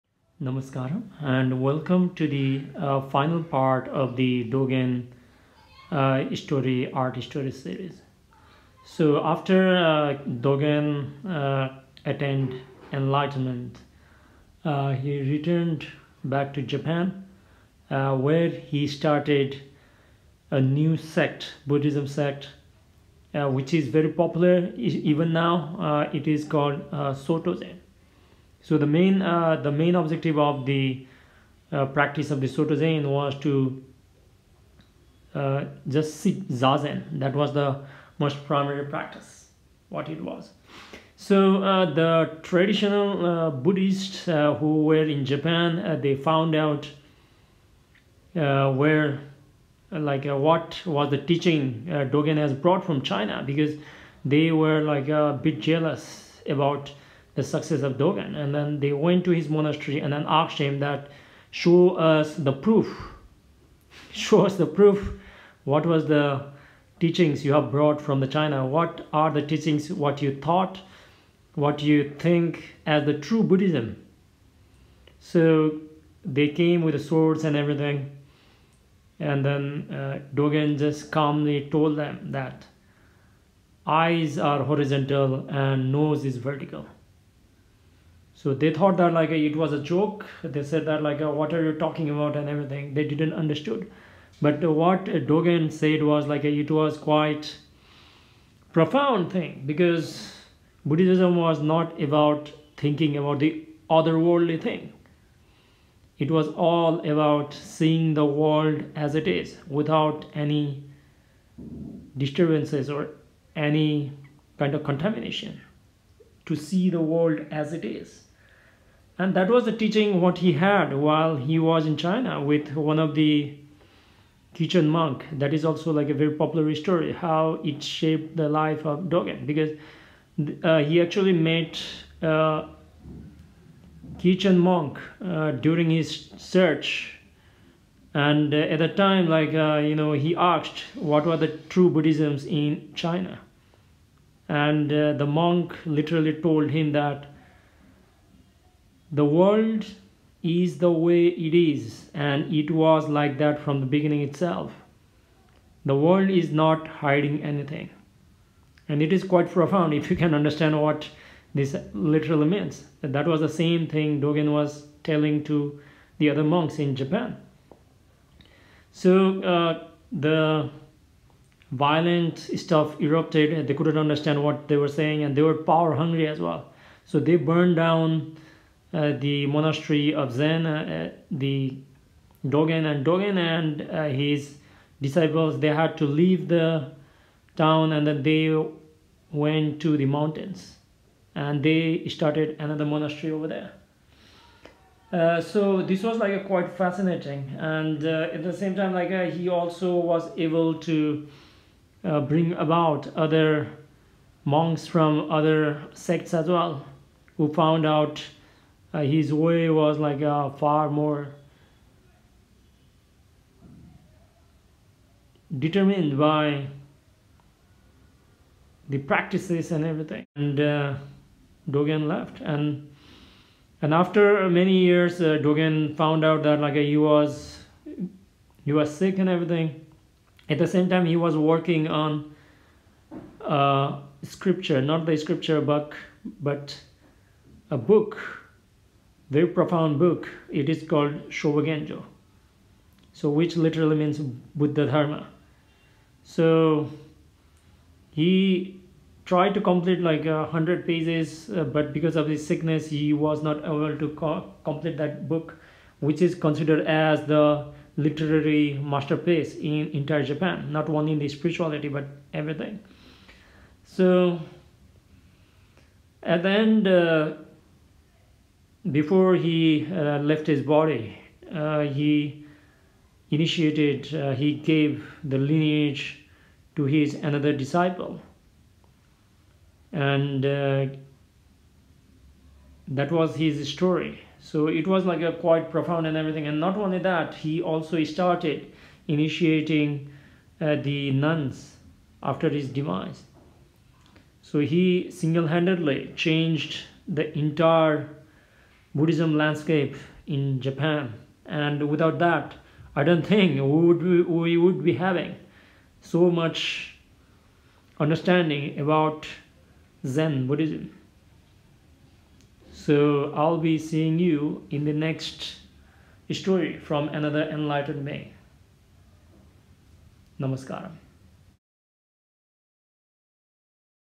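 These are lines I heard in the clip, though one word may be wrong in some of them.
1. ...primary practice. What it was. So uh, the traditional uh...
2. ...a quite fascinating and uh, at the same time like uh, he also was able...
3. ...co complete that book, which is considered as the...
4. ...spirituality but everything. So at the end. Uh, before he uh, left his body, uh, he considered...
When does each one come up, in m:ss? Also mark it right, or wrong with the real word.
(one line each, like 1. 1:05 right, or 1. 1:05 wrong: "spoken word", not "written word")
1. 0:38 right
2. 3:16 right
3. 4:14 right
4. 4:21 wrong: "initiated", not "considered".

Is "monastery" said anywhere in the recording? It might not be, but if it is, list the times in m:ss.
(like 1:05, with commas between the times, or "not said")
0:59, 2:59, 3:12.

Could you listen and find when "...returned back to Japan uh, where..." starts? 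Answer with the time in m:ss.
0:15.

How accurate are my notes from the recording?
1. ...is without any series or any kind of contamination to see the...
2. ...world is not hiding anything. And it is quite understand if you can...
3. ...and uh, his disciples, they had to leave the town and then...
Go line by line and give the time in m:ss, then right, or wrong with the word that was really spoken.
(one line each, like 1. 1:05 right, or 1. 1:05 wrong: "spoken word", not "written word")
1. 1:49 wrong: "disturbances", not "series"
2. 2:35 wrong: "profound", not "understand"
3. 3:03 right.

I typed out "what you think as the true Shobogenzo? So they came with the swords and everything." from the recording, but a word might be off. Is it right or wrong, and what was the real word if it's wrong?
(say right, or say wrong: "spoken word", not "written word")
wrong: "Buddhism", not "Shobogenzo".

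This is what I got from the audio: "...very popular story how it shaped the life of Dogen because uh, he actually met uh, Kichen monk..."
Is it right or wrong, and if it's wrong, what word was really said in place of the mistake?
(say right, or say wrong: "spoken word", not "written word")
right.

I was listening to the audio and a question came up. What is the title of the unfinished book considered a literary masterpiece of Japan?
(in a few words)
Shobogenzo.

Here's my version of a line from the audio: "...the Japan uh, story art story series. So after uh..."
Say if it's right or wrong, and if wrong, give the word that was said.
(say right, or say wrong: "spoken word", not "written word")
wrong: "Dogen", not "Japan".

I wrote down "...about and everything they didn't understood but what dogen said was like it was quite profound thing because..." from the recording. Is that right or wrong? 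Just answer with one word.
right.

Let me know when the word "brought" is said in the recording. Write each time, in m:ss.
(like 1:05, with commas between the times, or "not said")
0:52, 1:07.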